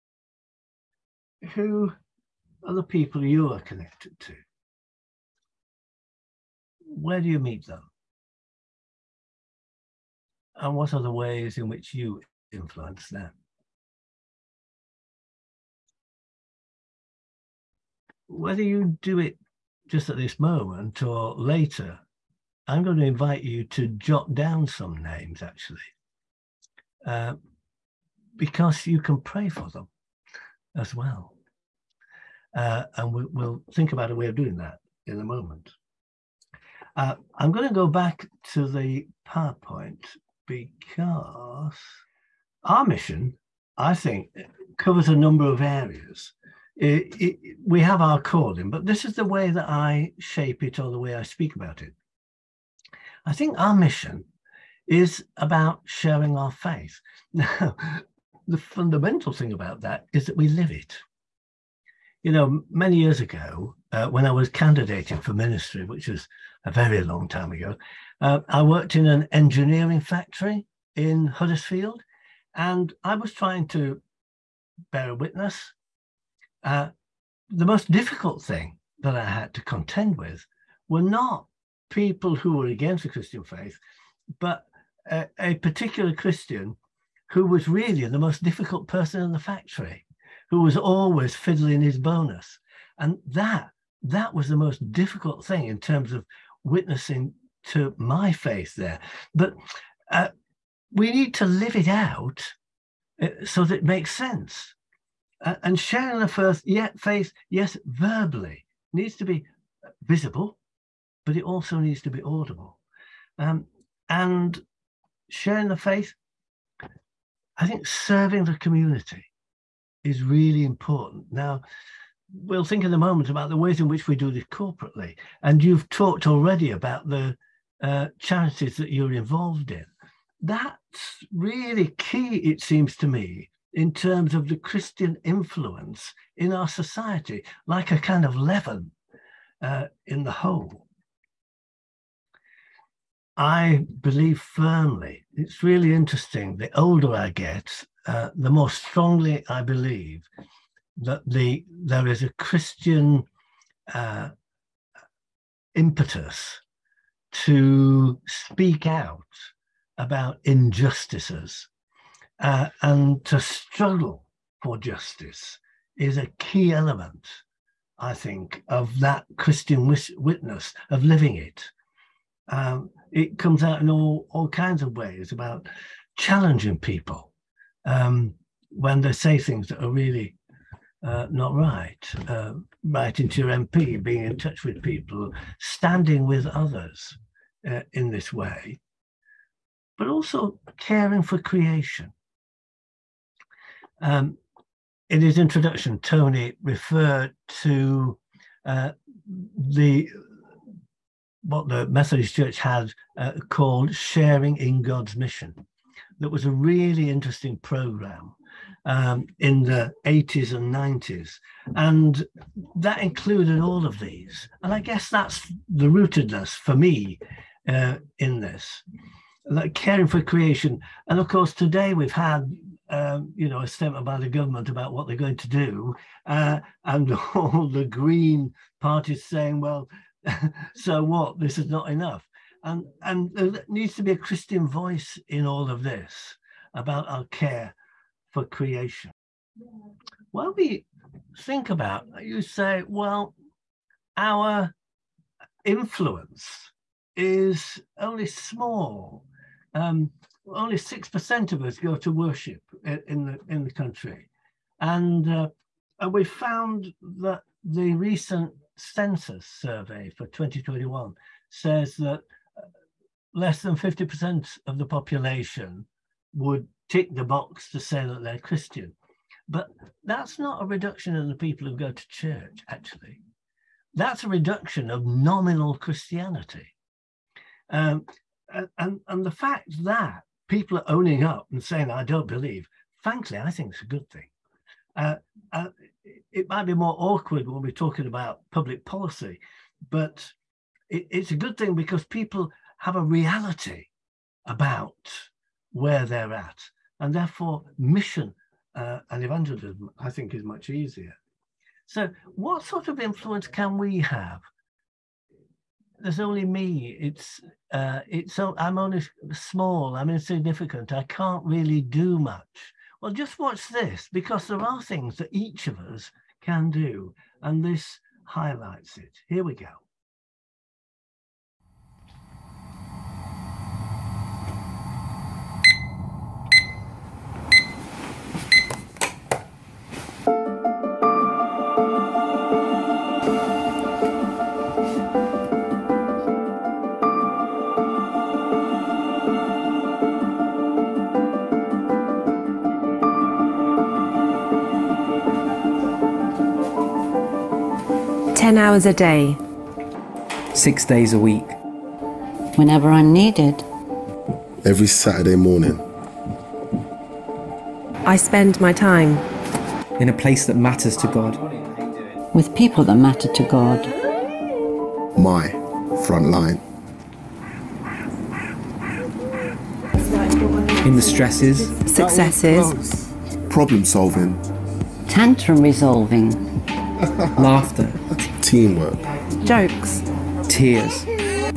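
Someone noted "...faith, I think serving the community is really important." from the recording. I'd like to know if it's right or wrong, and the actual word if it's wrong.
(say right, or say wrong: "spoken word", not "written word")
right.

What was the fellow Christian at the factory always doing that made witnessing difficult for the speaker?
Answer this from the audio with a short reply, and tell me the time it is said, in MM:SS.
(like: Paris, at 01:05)
Fiddling his bonus, at 01:31.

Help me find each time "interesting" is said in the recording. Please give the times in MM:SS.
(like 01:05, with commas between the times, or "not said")
02:25, 03:27.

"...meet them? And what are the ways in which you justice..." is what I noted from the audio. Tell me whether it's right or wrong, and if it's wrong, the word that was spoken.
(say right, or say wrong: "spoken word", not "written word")
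wrong: "influence", not "justice".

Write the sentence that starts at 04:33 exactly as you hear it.
That's a reduction of nominal Christianity.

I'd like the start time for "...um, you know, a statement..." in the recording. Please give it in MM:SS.
03:42.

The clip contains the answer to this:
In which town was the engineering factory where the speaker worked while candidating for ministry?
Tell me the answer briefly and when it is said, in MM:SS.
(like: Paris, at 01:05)
Huddersfield, at 01:11.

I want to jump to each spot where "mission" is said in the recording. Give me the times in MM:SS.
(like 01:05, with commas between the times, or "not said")
00:42, 00:53, 03:25, 04:57.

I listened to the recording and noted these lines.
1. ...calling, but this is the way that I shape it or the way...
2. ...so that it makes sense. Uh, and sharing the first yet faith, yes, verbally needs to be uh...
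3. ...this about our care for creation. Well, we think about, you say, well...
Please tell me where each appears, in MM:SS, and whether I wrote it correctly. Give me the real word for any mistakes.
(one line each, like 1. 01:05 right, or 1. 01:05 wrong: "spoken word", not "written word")
1. 00:48 right
2. 01:43 right
3. 03:55 right.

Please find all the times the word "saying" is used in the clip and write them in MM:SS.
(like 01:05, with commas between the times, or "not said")
03:49, 04:41.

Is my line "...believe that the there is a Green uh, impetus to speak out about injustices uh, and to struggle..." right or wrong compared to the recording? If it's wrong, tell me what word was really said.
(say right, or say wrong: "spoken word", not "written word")
wrong: "Christian", not "Green".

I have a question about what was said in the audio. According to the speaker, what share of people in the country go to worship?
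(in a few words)
6%.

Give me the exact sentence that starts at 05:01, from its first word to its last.
So, what sort of influence can we have?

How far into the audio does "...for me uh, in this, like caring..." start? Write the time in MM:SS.
03:36.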